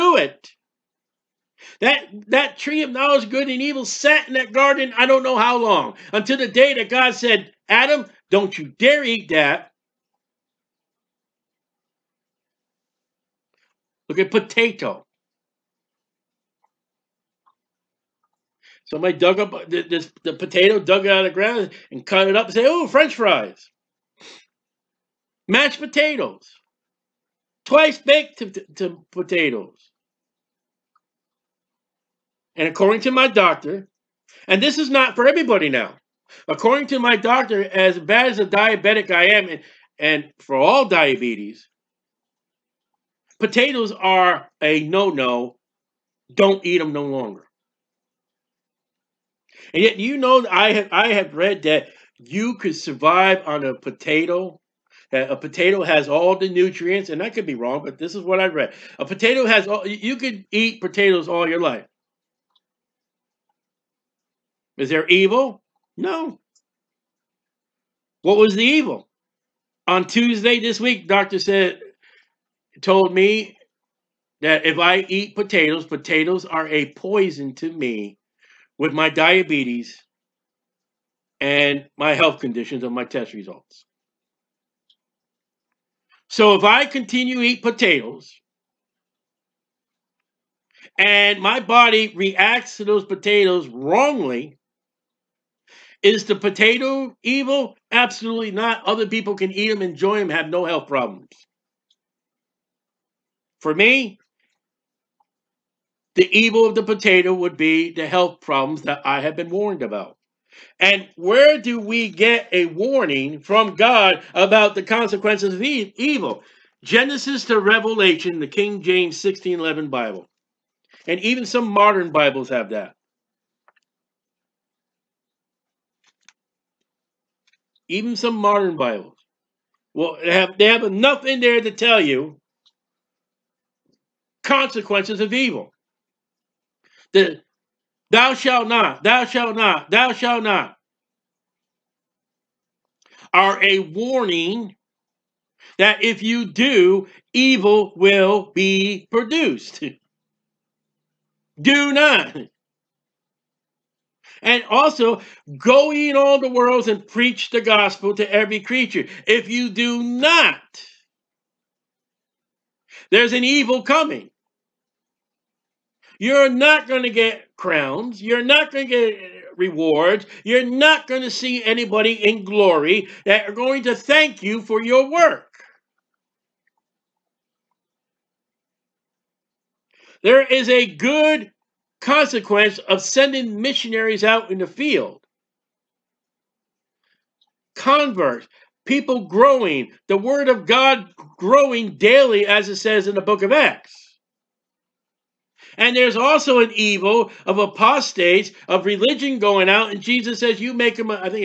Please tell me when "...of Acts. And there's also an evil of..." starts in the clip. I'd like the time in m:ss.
3:13.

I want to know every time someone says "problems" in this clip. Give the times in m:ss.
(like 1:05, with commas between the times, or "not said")
1:40, 1:48.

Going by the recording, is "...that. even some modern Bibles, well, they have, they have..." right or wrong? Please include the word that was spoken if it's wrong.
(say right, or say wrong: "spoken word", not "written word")
right.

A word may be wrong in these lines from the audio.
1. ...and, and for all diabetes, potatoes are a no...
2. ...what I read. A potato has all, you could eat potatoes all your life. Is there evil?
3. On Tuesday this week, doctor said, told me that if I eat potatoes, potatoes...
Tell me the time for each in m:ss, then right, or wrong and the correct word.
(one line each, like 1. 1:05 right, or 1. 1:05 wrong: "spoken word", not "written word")
1. 0:39 right
2. 0:58 right
3. 1:09 right.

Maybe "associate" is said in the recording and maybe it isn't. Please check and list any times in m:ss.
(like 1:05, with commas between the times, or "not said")
not said.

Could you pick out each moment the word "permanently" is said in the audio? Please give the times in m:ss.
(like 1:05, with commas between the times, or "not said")
not said.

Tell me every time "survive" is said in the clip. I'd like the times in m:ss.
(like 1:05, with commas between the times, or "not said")
0:52.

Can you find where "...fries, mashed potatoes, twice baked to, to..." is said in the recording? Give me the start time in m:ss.
0:23.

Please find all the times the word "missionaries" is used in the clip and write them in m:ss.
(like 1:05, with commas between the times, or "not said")
3:03.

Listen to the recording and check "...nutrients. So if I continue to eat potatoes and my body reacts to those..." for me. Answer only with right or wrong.
wrong.